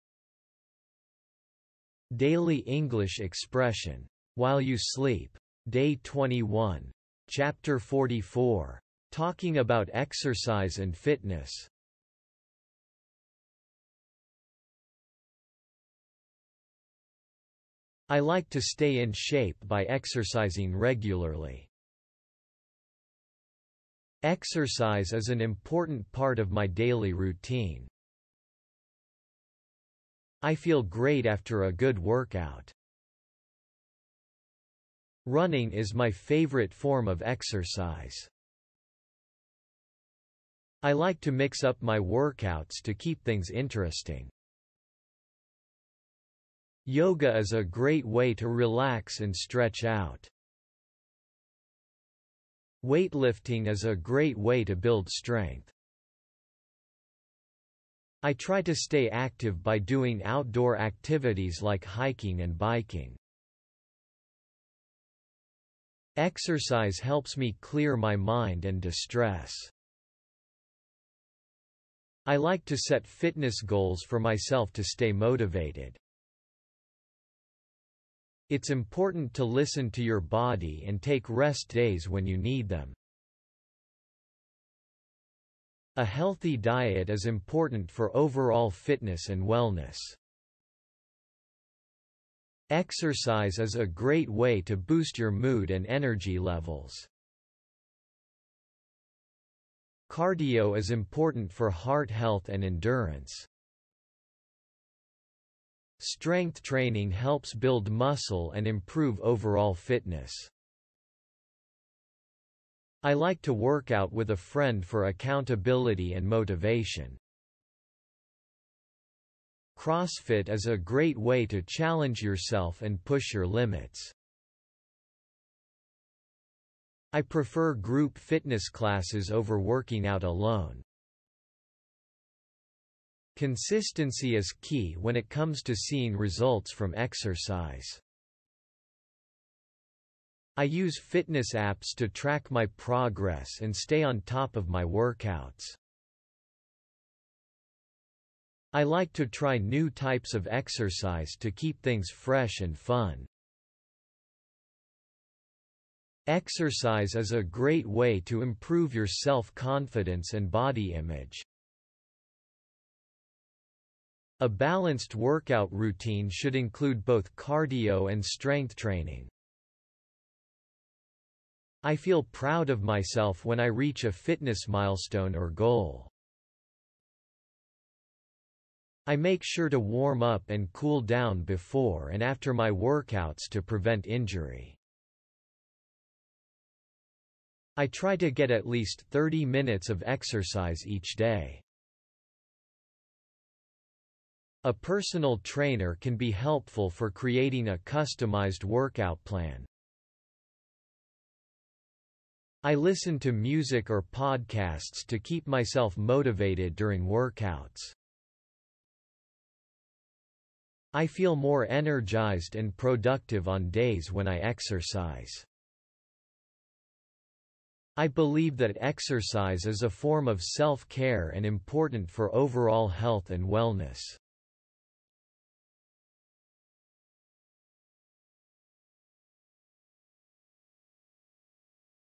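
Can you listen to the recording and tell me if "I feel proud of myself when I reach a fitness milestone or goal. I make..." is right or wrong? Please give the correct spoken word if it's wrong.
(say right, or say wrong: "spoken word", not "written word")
right.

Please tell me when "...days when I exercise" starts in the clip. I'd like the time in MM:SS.
03:33.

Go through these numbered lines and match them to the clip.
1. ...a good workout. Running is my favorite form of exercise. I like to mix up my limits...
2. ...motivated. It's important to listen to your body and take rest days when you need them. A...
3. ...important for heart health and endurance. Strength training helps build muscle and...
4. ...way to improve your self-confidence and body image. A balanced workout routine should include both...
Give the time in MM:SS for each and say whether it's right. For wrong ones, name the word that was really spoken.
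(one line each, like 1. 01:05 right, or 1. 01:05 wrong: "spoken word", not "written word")
1. 00:31 wrong: "workouts", not "limits"
2. 01:15 right
3. 01:40 right
4. 02:37 right.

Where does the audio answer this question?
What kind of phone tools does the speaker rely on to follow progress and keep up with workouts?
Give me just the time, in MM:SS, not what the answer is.
02:20.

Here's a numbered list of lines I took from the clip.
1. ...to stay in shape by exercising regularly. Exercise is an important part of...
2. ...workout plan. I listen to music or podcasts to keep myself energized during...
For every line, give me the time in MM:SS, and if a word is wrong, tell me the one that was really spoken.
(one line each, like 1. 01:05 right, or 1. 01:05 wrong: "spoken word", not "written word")
1. 00:18 right
2. 03:18 wrong: "motivated", not "energized".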